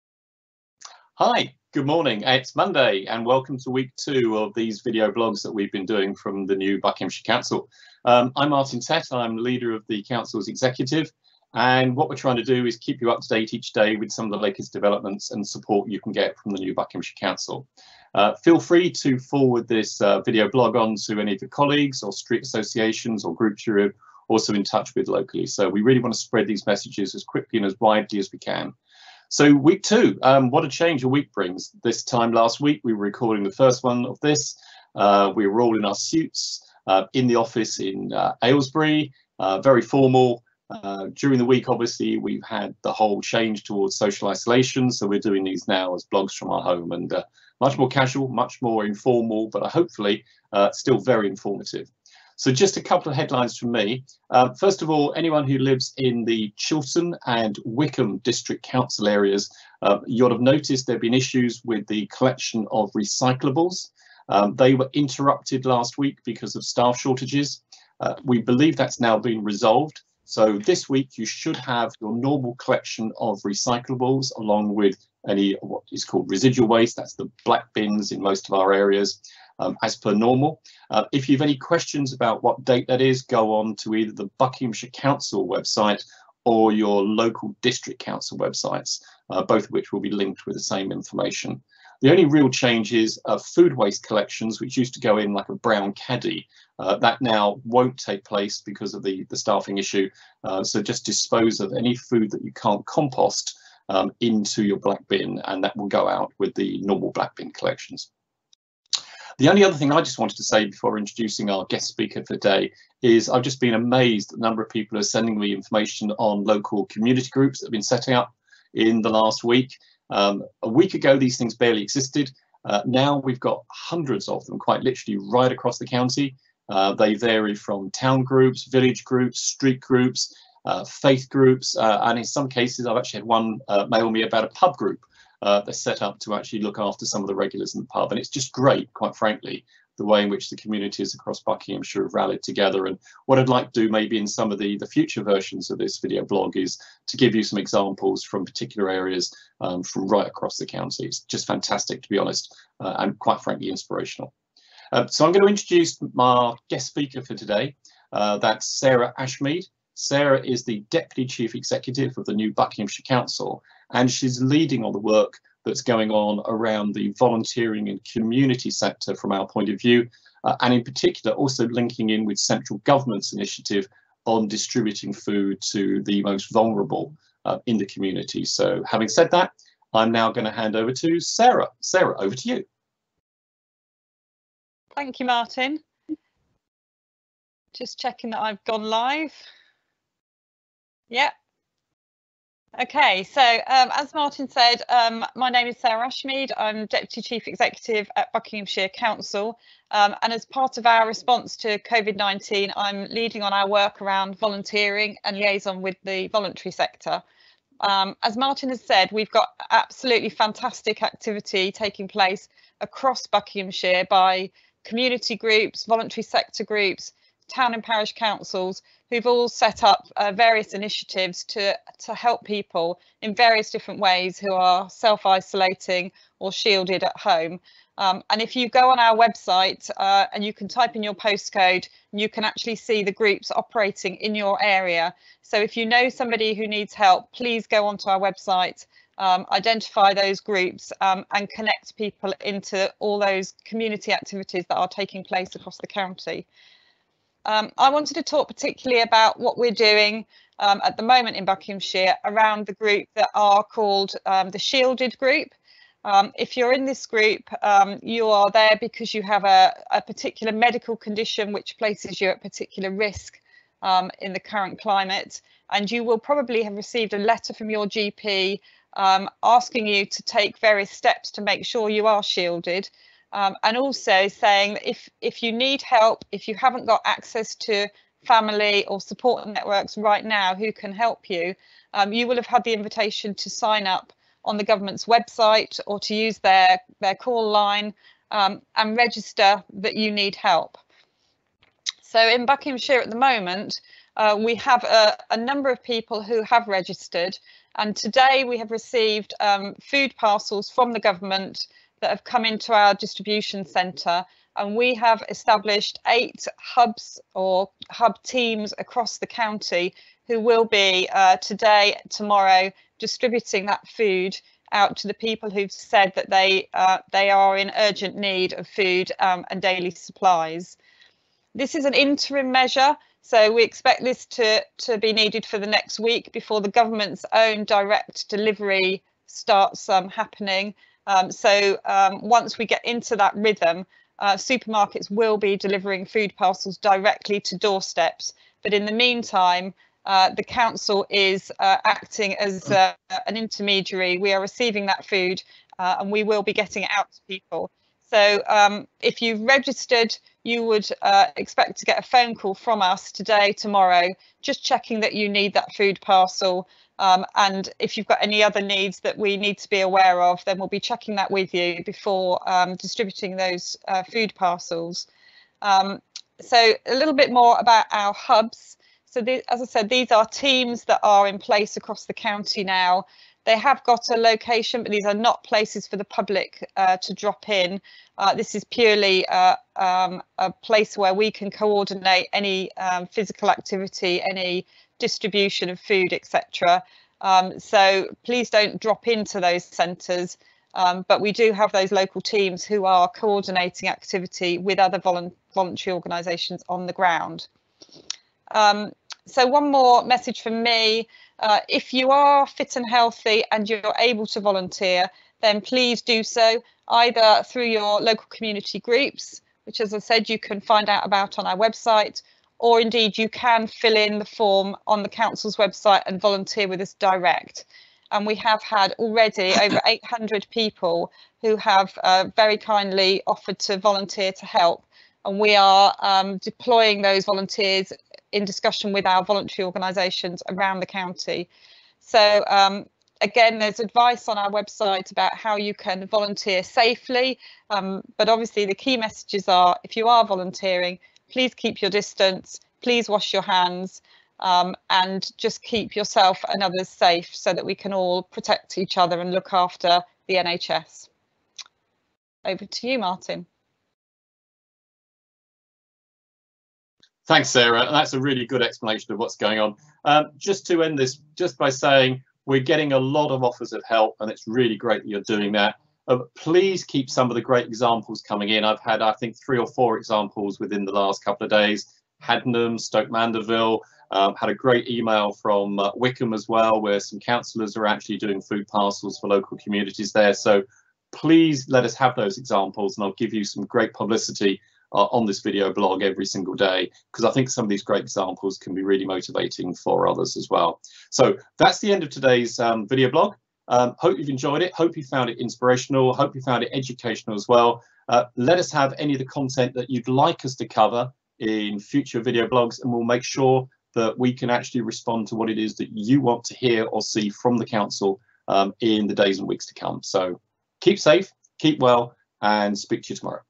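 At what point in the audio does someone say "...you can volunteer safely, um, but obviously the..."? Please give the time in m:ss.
7:15.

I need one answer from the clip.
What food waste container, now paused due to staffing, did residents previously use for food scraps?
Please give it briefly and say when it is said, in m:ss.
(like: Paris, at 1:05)
brown caddy, at 1:35.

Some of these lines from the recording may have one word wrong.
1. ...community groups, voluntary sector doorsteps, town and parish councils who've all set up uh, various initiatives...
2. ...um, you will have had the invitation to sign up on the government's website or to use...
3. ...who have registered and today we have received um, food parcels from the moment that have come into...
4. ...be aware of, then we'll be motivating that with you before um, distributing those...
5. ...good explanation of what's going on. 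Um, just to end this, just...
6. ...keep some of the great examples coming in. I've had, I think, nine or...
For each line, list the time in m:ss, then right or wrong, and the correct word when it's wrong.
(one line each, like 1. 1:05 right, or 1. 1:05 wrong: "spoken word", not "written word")
1. 3:34 wrong: "groups", not "doorsteps"
2. 4:41 right
3. 4:56 wrong: "government", not "moment"
4. 5:59 wrong: "checking", not "motivating"
5. 7:38 right
6. 7:46 wrong: "three", not "nine".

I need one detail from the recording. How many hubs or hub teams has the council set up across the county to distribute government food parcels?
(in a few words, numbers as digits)
8.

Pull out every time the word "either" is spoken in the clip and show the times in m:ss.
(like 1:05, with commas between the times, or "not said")
1:23, 6:46.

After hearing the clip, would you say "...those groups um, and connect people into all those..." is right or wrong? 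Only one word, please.
right.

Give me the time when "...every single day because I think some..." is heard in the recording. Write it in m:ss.
8:06.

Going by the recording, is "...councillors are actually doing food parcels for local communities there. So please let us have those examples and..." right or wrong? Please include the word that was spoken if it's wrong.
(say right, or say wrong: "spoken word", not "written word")
right.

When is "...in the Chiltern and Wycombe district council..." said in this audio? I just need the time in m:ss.
0:55.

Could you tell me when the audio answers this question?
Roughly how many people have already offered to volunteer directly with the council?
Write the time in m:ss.
6:59.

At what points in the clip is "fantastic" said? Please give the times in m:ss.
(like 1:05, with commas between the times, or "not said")
2:31, 3:30.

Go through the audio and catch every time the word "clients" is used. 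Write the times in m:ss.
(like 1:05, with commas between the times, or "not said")
not said.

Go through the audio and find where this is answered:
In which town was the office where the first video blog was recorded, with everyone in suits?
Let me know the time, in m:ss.
0:38.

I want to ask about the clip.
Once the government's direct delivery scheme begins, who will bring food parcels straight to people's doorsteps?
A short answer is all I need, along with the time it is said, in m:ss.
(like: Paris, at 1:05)
supermarkets, at 5:34.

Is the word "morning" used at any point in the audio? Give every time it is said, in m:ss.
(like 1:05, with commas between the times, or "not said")
0:01.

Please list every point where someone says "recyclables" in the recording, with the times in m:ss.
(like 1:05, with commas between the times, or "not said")
1:02, 1:13.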